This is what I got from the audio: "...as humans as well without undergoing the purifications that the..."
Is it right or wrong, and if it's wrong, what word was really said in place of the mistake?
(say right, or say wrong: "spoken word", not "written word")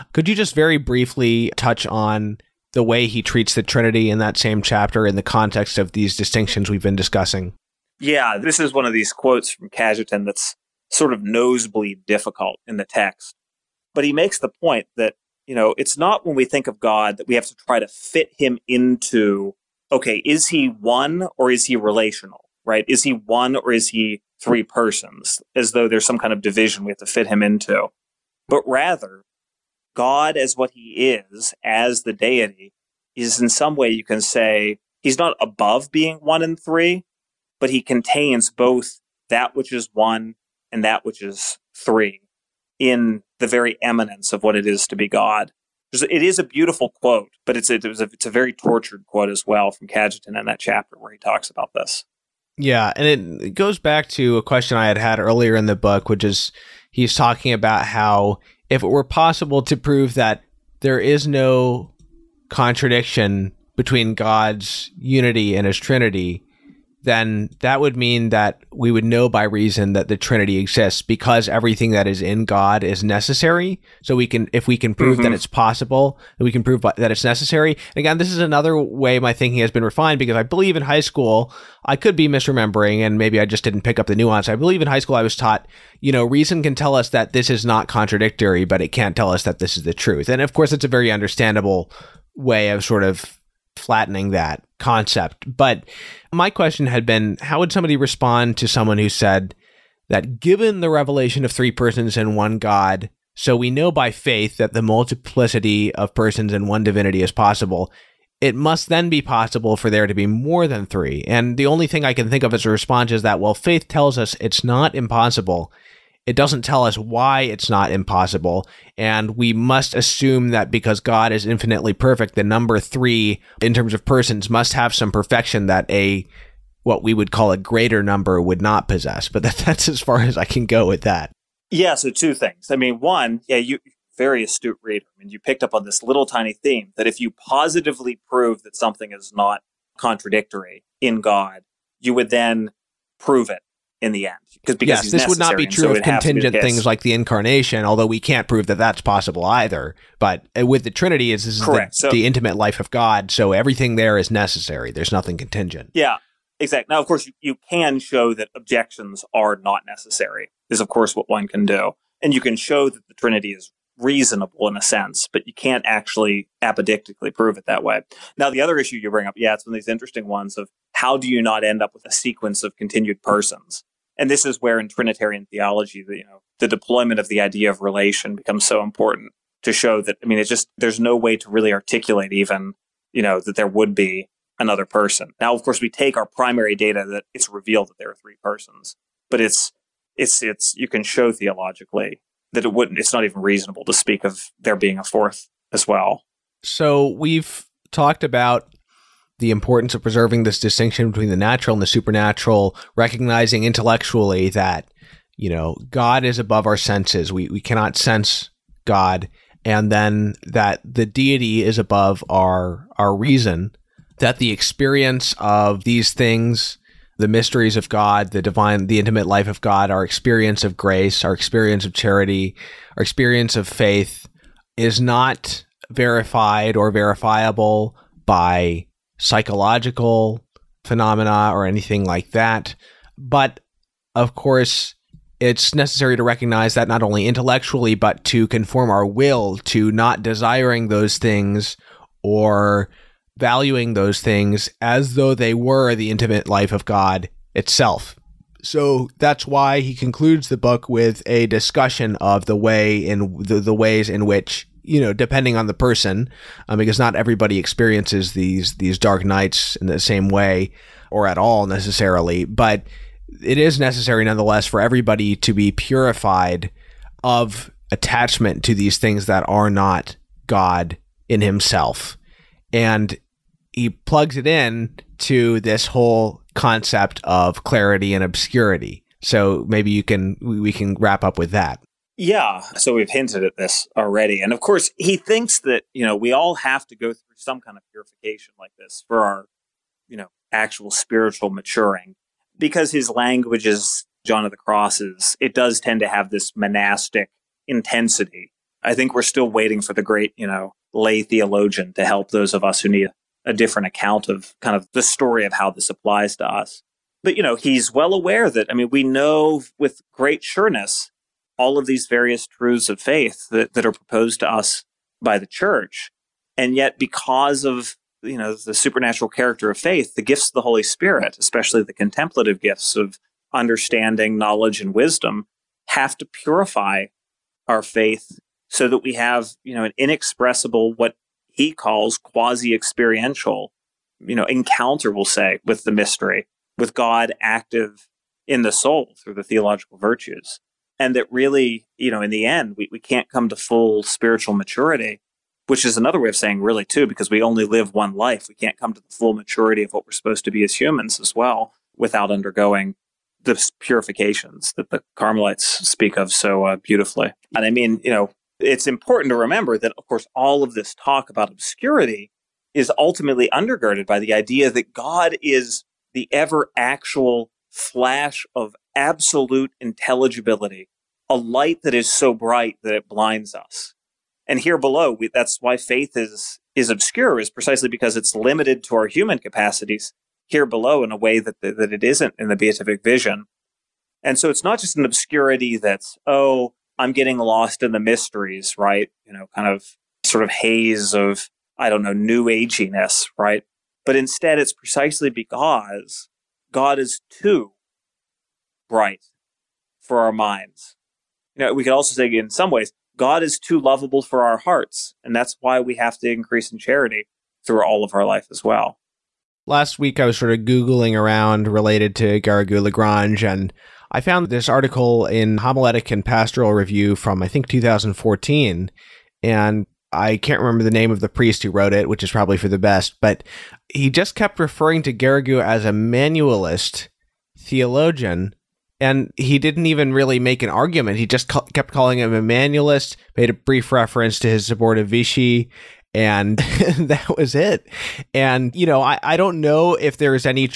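right.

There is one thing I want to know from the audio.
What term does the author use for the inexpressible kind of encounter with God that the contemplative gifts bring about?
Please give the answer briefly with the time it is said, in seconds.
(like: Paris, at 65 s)
quasi experiential, at 332 s.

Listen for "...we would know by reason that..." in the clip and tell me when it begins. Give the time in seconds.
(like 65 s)
68 s.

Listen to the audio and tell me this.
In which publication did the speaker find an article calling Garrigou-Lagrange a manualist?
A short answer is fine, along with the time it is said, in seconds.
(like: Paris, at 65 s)
Homiletic and Pastoral Review, at 415 s.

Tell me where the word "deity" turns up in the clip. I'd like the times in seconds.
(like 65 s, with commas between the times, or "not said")
32 s, 211 s.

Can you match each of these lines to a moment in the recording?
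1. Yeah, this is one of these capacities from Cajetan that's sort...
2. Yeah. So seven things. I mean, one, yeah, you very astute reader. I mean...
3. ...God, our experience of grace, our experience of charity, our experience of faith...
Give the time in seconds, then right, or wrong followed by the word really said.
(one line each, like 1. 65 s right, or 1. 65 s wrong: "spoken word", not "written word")
1. 7 s wrong: "quotes", not "capacities"
2. 131 s wrong: "two", not "seven"
3. 219 s right.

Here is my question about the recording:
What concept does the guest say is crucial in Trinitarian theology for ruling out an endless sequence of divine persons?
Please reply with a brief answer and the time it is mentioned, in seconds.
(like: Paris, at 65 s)
relation, at 177 s.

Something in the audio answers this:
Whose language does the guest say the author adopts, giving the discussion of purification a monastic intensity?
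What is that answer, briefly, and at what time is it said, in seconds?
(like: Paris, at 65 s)
John of the Cross, at 294 s.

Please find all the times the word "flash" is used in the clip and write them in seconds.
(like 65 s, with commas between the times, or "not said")
367 s.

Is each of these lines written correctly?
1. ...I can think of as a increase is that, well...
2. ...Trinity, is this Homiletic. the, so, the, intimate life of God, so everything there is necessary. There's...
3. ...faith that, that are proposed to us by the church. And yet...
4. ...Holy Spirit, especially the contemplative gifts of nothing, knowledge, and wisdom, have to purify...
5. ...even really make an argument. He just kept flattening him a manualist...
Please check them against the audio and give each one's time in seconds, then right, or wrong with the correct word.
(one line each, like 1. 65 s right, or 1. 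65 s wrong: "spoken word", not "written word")
1. 112 s wrong: "response", not "increase"
2. 150 s wrong: "Correct", not "Homiletic"
3. 313 s right
4. 320 s wrong: "understanding", not "nothing"
5. 429 s wrong: "calling", not "flattening".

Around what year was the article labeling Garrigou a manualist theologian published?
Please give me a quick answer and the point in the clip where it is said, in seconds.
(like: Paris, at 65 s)
2014, at 417 s.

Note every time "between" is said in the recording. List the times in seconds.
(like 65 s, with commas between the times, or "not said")
63 s, 201 s.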